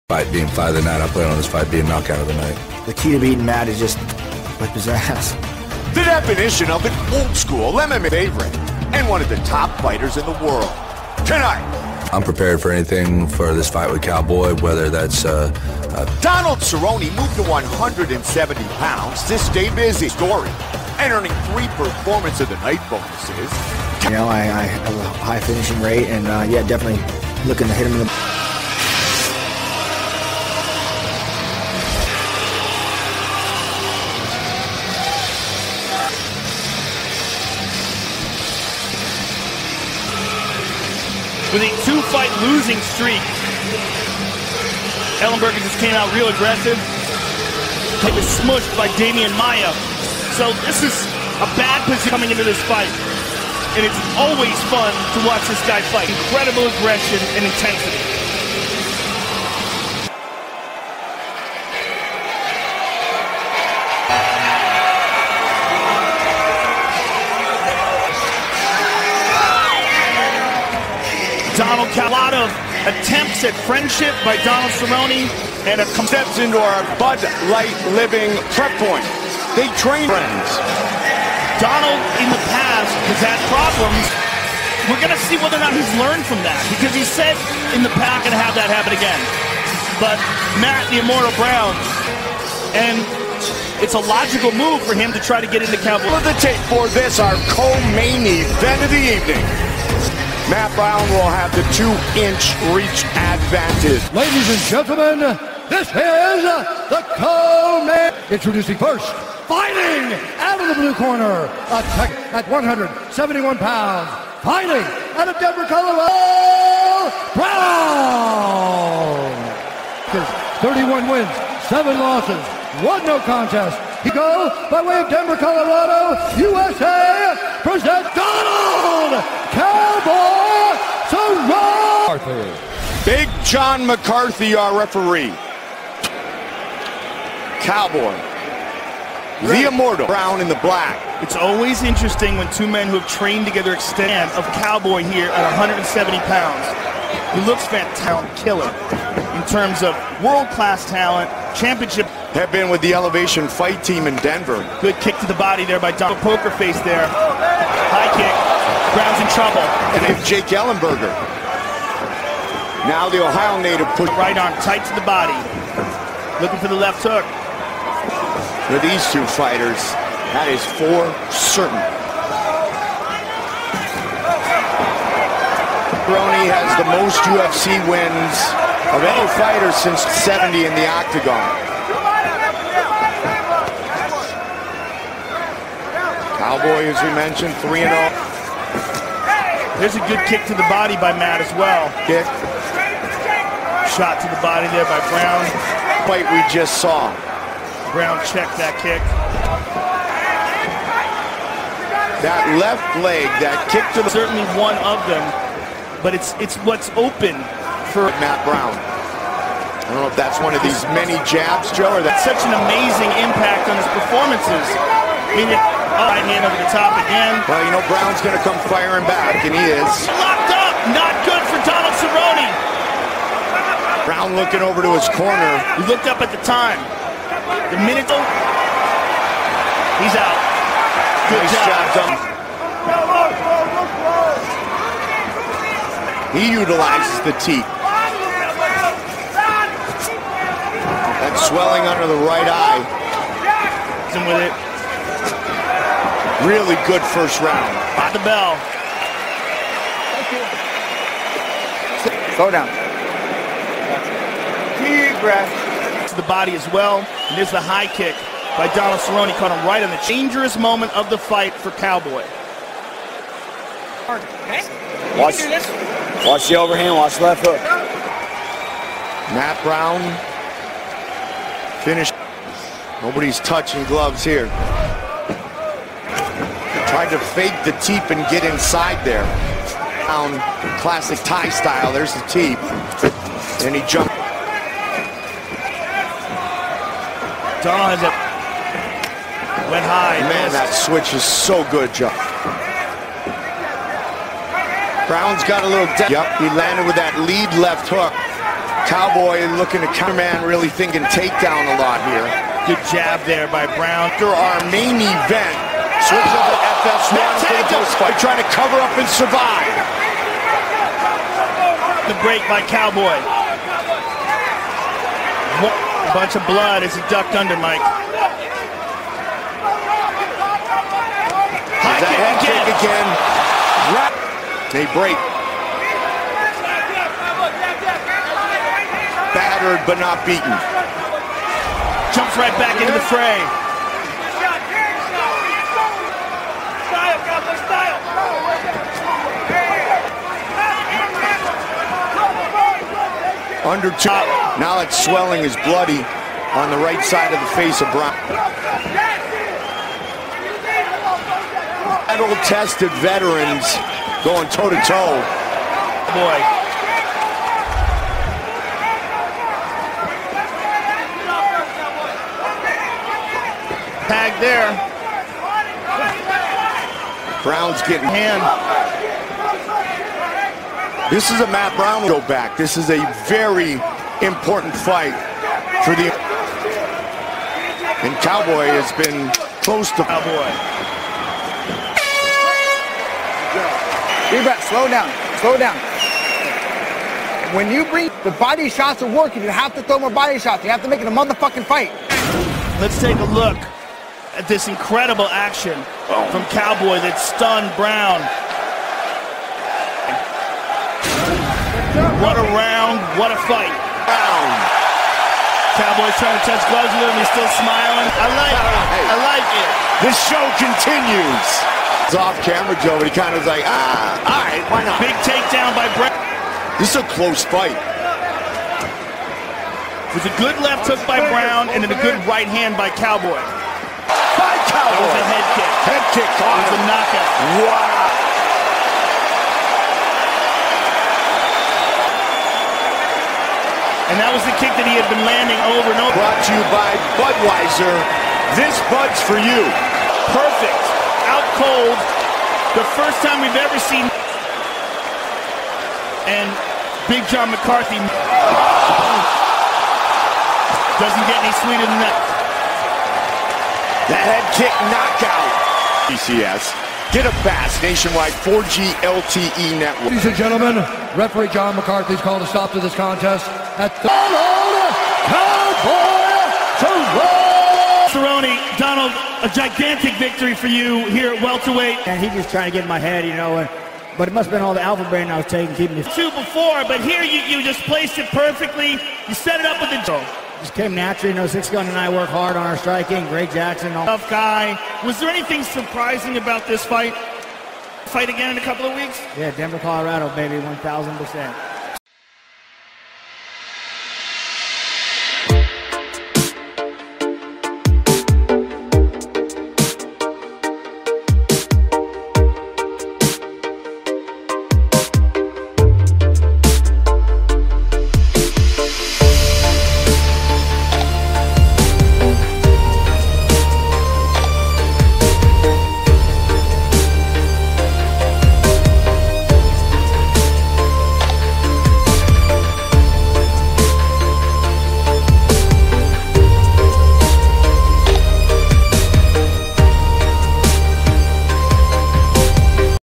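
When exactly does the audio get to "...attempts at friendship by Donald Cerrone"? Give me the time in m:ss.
1:12.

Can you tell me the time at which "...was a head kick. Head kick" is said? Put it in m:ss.
7:05.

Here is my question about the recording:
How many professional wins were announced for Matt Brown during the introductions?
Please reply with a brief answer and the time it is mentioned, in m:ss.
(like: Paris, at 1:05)
31 wins, at 2:00.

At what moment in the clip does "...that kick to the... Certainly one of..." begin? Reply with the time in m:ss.
3:23.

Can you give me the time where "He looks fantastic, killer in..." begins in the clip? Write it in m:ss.
2:27.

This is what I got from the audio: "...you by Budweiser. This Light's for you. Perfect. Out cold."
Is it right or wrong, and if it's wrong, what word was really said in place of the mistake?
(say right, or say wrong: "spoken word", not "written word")
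wrong: "Bud", not "Light".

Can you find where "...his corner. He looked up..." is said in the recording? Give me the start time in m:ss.
3:44.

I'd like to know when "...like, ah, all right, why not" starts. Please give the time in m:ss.
6:53.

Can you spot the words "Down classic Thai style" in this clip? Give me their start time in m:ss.
4:40.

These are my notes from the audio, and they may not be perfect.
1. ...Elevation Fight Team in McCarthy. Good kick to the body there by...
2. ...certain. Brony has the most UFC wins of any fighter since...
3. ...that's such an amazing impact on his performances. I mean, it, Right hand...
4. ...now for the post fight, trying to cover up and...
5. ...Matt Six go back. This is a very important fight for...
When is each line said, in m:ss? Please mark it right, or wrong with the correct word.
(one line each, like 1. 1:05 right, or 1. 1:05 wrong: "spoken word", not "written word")
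1. 2:32 wrong: "Denver", not "McCarthy"
2. 2:51 right
3. 3:32 right
4. 5:07 right
5. 6:11 wrong: "Brown", not "Six".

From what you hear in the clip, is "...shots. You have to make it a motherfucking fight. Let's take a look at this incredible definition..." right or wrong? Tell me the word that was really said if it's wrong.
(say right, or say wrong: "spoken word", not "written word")
wrong: "action", not "definition".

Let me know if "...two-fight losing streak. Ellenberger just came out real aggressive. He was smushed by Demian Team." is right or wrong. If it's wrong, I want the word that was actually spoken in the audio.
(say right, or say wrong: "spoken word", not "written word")
wrong: "Maia", not "Team".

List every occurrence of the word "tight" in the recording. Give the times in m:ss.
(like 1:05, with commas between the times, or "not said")
2:44.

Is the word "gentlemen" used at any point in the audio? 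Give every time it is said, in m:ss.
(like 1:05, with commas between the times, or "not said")
1:44, 7:40.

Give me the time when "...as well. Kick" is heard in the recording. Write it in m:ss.
3:11.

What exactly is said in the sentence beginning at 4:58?
Cowboy looking to counterman, really thinking takedown a lot here.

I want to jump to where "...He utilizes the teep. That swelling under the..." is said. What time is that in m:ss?
3:56.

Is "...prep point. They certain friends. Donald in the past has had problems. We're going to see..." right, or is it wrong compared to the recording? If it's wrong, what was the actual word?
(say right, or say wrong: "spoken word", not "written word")
wrong: "train", not "certain".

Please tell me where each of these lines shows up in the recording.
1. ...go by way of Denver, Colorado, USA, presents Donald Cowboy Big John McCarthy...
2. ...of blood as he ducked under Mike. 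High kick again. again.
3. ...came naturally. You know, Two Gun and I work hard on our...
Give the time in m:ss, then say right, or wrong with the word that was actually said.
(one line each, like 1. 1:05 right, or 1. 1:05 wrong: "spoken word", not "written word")
1. 2:04 right
2. 5:16 right
3. 8:00 wrong: "Six", not "Two".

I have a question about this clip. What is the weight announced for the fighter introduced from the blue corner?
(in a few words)
171 pounds.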